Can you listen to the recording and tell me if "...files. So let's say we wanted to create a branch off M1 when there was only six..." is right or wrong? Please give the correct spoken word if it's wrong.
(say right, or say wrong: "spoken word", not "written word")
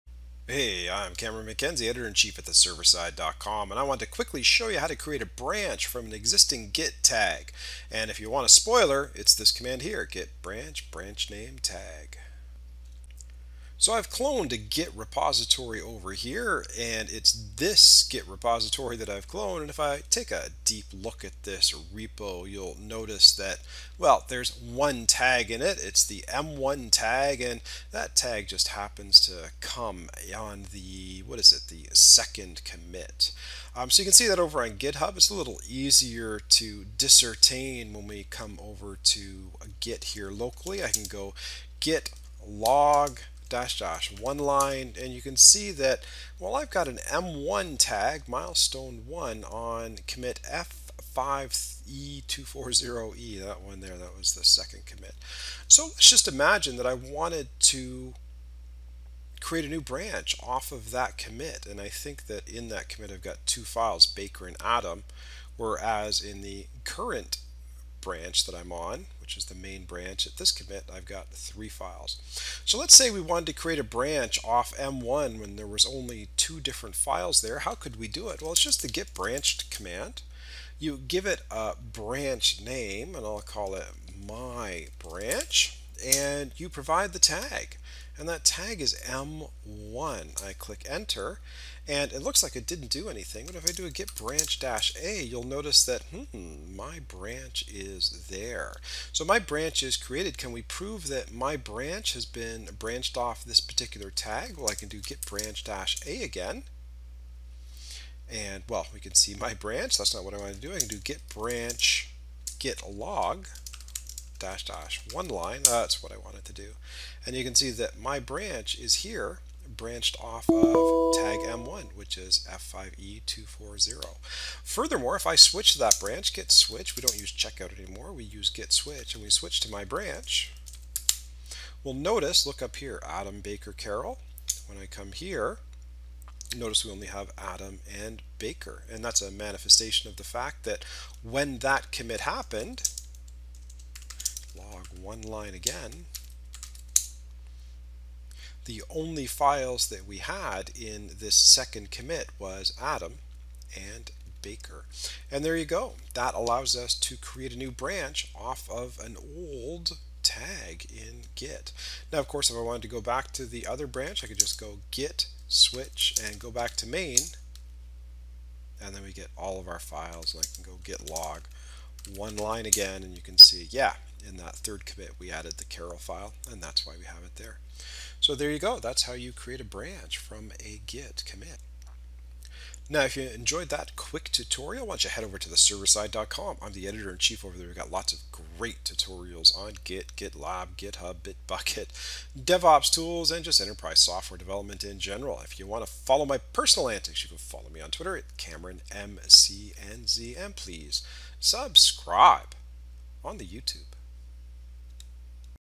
wrong: "two", not "six".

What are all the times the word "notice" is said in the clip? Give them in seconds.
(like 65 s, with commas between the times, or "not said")
22 s, 95 s, 131 s, 136 s.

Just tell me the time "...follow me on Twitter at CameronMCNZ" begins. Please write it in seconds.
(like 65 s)
197 s.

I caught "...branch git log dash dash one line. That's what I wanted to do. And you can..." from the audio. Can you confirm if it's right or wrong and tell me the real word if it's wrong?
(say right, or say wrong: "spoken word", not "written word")
right.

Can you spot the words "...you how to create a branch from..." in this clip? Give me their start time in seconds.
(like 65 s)
4 s.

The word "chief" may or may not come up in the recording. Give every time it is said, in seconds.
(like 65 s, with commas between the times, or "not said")
1 s, 186 s.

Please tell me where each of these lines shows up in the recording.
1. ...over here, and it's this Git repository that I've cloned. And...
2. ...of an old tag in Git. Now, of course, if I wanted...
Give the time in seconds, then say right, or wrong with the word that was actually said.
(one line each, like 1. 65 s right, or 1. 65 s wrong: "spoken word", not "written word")
1. 15 s right
2. 158 s right.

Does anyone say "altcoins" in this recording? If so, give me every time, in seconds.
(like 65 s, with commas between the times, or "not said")
not said.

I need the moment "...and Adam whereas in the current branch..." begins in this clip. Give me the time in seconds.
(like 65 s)
64 s.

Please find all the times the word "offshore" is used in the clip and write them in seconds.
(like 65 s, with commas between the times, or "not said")
not said.